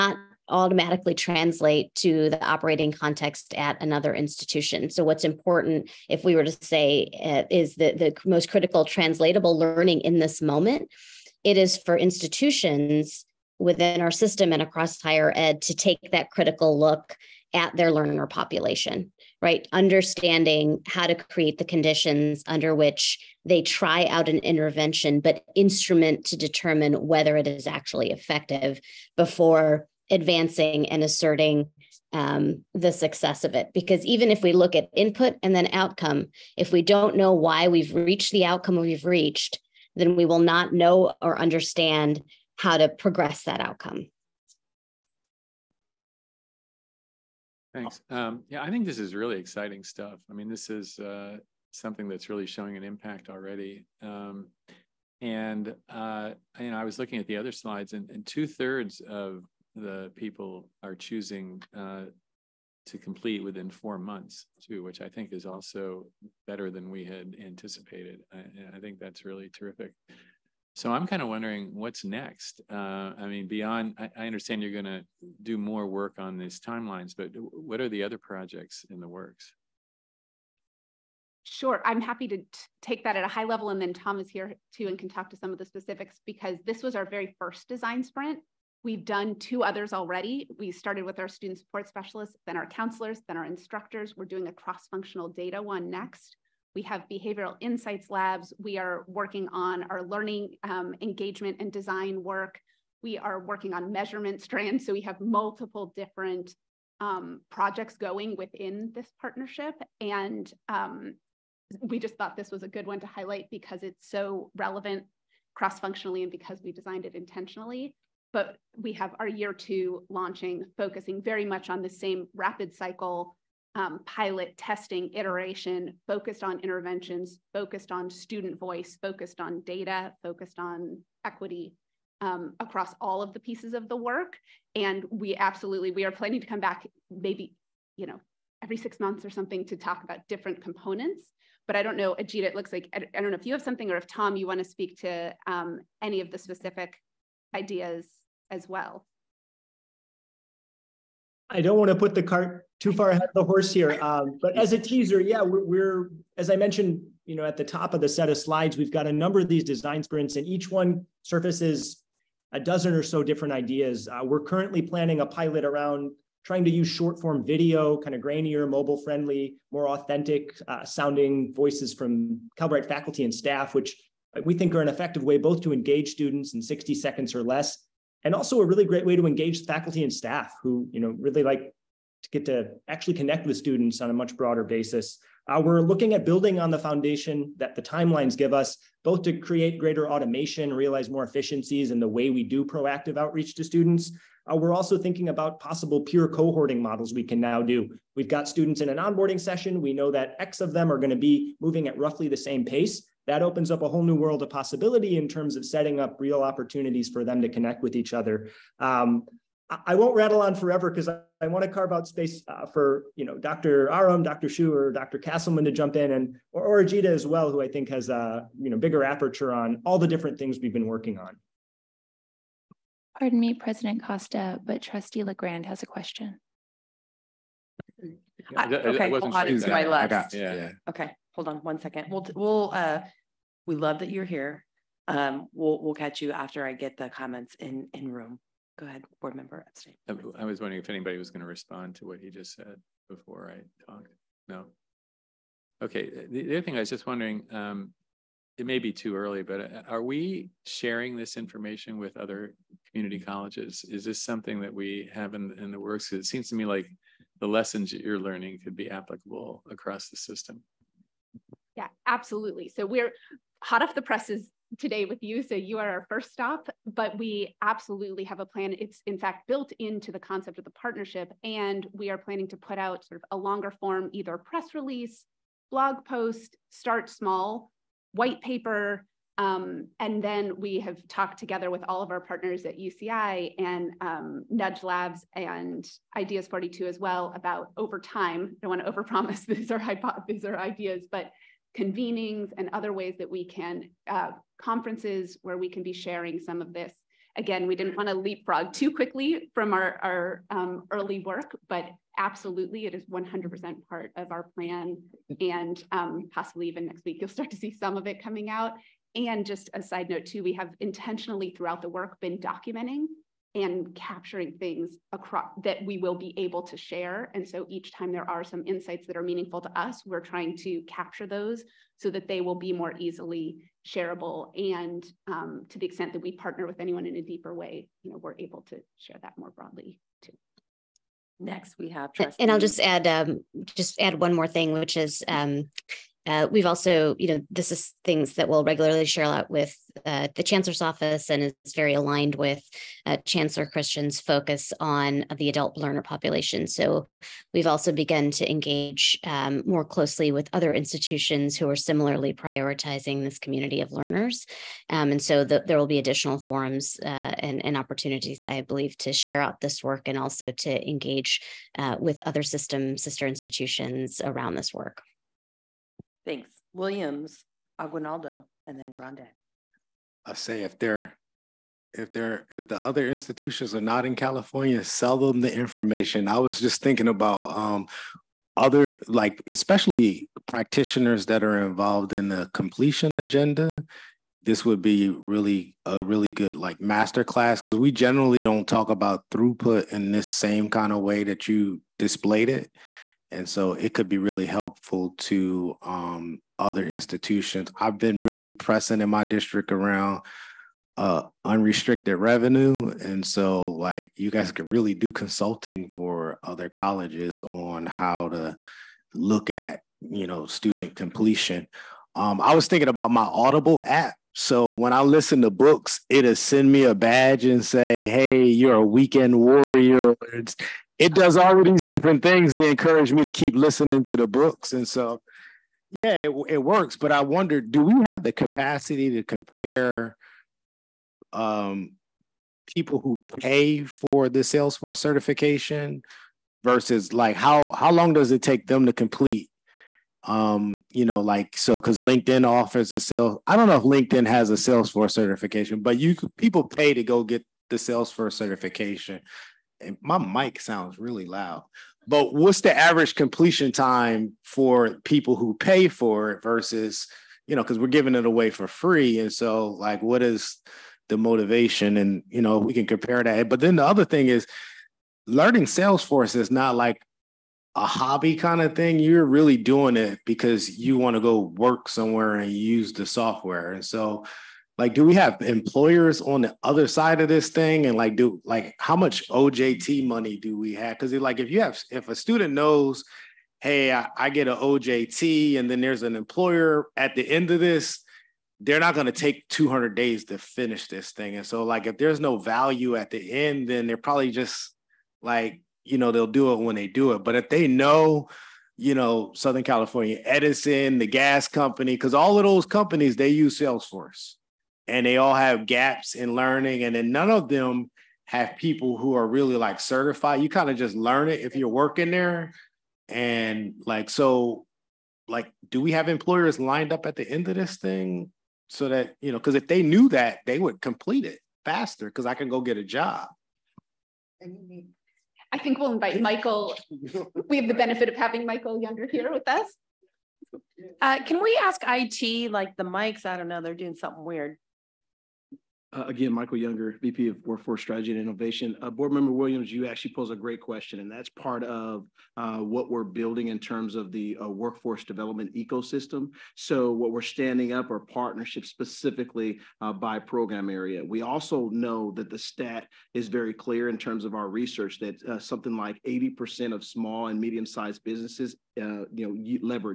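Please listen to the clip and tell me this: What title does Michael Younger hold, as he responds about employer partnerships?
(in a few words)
VP of Workforce Strategy and Innovation.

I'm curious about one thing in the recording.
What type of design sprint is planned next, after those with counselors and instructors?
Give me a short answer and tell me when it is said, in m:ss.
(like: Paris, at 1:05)
cross-functional data, at 1:34.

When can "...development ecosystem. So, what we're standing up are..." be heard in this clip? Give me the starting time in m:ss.
9:05.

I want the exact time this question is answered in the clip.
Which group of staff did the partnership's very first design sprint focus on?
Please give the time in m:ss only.
1:31.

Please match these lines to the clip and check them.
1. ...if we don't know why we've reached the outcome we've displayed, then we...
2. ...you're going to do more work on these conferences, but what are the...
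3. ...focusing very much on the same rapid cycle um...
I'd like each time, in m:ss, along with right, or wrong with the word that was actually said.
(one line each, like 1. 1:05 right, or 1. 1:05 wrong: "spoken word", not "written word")
1. 0:36 wrong: "reached", not "displayed"
2. 1:14 wrong: "timelines", not "conferences"
3. 2:00 right.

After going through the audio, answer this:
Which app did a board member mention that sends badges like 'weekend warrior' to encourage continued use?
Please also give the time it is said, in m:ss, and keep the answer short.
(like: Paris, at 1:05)
Audible, at 6:53.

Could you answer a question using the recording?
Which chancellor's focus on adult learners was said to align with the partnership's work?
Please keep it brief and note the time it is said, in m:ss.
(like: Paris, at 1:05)
Chancellor Christian, at 5:43.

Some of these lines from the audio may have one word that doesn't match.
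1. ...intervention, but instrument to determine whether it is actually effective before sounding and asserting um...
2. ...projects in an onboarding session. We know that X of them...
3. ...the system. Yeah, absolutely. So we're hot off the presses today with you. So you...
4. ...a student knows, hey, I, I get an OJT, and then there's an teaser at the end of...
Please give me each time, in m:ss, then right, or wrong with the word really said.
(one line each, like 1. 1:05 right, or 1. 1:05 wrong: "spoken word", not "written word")
1. 0:24 wrong: "advancing", not "sounding"
2. 3:18 wrong: "students", not "projects"
3. 4:20 right
4. 8:02 wrong: "employer", not "teaser".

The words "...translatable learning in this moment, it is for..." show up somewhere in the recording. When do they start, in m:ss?
0:08.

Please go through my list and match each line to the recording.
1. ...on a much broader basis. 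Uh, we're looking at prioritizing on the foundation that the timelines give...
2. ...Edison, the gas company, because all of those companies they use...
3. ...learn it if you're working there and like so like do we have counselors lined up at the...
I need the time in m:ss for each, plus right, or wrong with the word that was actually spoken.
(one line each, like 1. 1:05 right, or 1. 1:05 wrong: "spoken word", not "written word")
1. 3:04 wrong: "building", not "prioritizing"
2. 8:20 right
3. 8:30 wrong: "employers", not "counselors".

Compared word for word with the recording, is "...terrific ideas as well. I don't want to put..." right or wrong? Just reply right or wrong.
wrong.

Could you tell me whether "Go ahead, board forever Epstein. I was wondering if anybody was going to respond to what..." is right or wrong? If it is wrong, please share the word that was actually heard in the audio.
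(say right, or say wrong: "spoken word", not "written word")
wrong: "member", not "forever".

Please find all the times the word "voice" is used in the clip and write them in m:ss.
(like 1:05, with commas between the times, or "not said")
2:08, 2:51.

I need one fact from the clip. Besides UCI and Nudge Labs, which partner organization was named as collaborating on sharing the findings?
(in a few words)
Ideas 42.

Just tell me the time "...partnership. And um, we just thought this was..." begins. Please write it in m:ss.
1:49.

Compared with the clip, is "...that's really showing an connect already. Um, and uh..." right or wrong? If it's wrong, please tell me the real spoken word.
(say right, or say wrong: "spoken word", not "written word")
wrong: "impact", not "connect".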